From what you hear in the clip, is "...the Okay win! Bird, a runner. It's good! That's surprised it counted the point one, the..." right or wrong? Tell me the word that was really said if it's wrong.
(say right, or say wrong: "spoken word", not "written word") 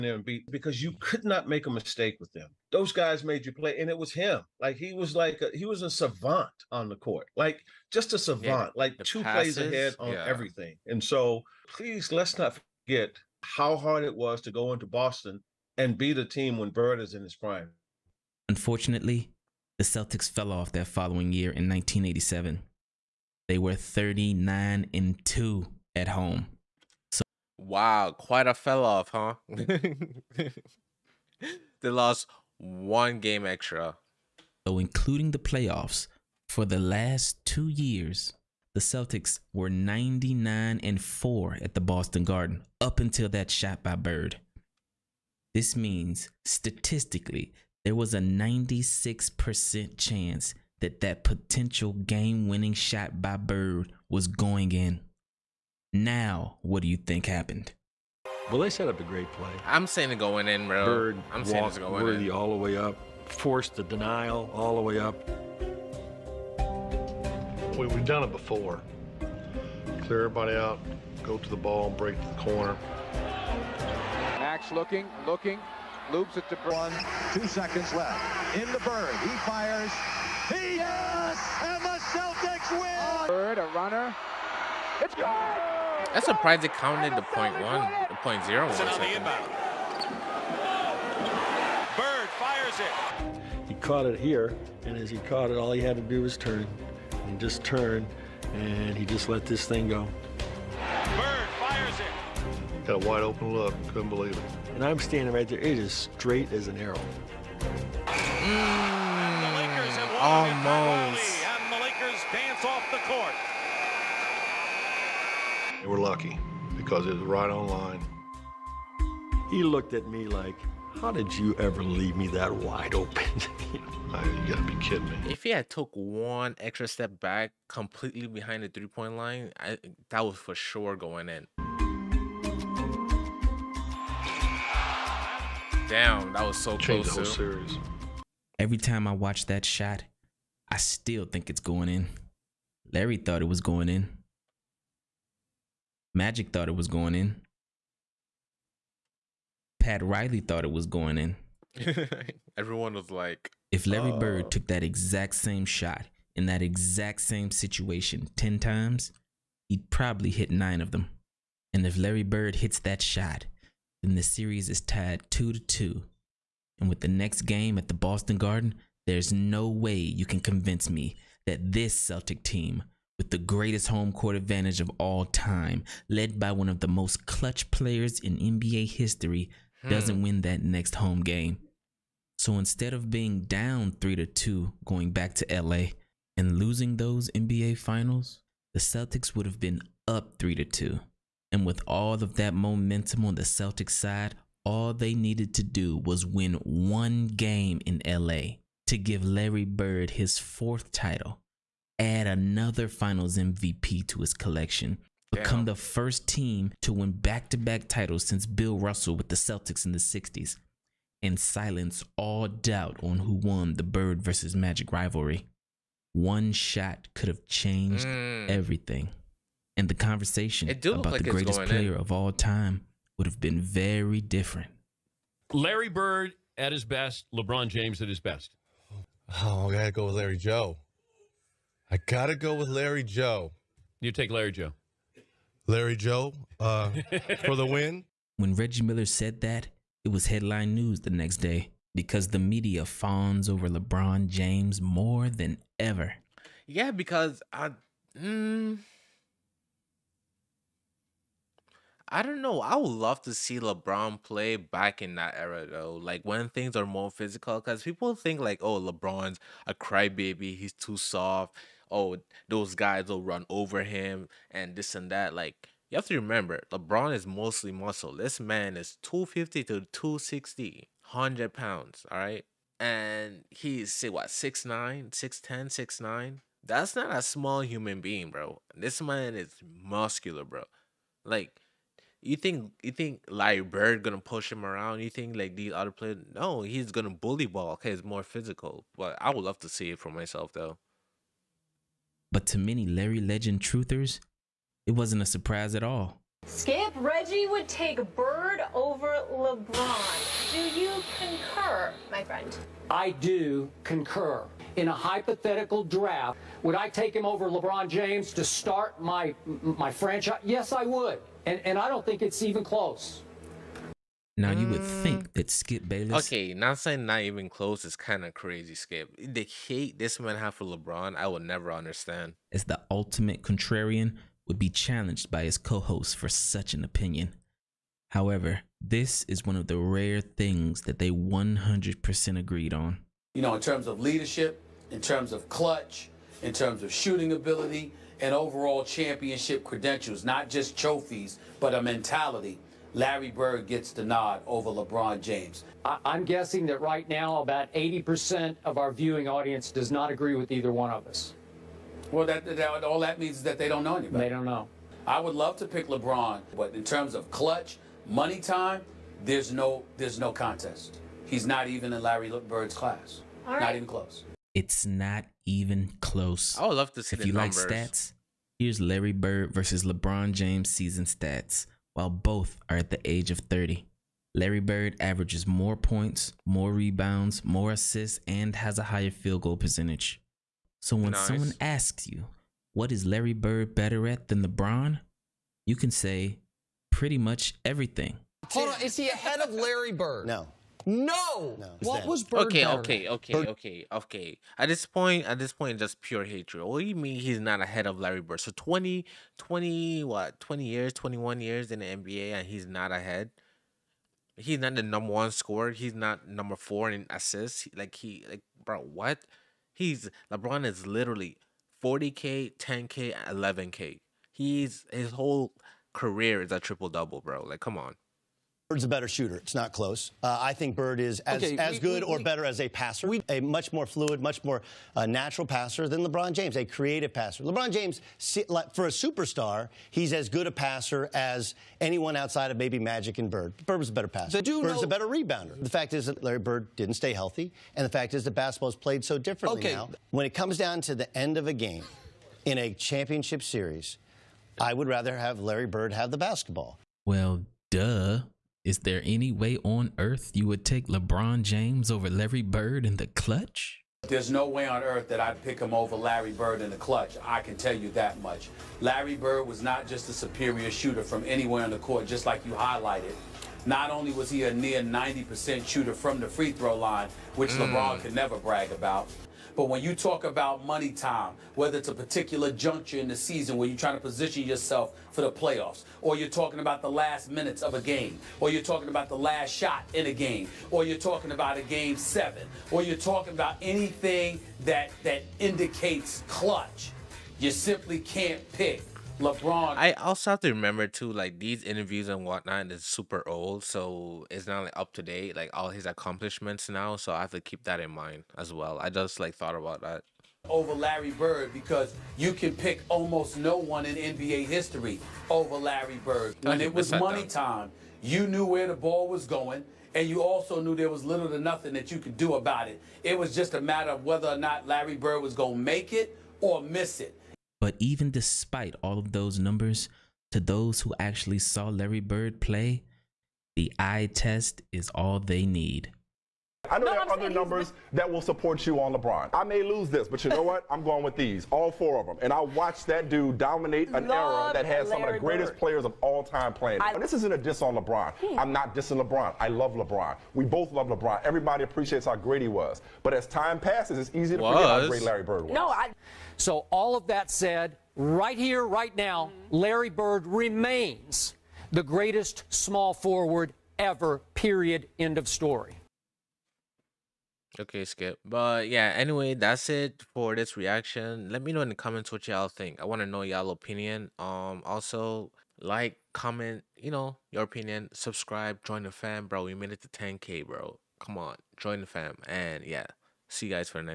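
wrong: "Celtics", not "Okay".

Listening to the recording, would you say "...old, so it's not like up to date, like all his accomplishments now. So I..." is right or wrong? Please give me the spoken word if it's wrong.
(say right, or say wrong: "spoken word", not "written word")
right.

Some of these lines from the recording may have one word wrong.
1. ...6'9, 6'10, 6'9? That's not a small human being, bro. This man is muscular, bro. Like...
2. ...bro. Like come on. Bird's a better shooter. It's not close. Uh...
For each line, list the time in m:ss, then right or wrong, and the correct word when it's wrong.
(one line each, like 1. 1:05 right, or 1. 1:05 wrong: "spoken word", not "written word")
1. 4:34 right
2. 6:57 right.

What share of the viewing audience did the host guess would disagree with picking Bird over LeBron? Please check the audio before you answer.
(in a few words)
80%.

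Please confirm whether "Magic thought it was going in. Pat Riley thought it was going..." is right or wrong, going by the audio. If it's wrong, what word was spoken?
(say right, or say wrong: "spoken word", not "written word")
right.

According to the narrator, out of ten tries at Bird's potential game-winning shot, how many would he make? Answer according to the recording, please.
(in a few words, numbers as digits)
9.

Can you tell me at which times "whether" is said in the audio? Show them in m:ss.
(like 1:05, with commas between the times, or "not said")
7:51, 8:34.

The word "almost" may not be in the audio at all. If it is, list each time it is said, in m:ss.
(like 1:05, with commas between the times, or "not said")
1:50, 8:22.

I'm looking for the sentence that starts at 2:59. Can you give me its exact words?
doesn't win that next home game.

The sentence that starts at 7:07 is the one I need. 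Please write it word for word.
LeBron James, for a superstar, he's as good a passer as anyone outside of maybe Magic and Bird.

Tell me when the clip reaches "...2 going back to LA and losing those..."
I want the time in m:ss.
3:04.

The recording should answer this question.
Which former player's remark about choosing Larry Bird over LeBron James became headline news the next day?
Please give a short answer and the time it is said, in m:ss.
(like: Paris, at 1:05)
Reggie Miller, at 3:58.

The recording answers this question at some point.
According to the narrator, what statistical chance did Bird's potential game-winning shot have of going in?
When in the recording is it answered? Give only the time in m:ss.
0:48.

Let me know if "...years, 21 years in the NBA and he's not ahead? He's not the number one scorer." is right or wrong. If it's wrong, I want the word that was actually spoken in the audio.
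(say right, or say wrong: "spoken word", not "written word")
right.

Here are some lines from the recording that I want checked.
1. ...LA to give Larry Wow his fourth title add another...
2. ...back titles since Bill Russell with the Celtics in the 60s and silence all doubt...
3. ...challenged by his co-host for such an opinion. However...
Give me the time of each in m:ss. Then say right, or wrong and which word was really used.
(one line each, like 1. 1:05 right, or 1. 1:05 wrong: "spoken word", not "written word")
1. 3:18 wrong: "Bird", not "Wow"
2. 3:27 right
3. 5:24 right.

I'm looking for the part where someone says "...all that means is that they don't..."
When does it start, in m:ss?
5:52.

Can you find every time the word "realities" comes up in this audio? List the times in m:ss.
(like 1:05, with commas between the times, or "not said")
not said.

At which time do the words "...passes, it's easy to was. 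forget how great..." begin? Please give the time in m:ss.
9:03.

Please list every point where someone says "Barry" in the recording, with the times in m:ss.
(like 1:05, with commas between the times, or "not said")
not said.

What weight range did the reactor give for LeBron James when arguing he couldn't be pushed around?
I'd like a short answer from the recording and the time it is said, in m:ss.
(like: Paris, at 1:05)
250 to 260, at 4:29.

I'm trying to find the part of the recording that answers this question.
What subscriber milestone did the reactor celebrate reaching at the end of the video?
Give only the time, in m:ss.
9:29.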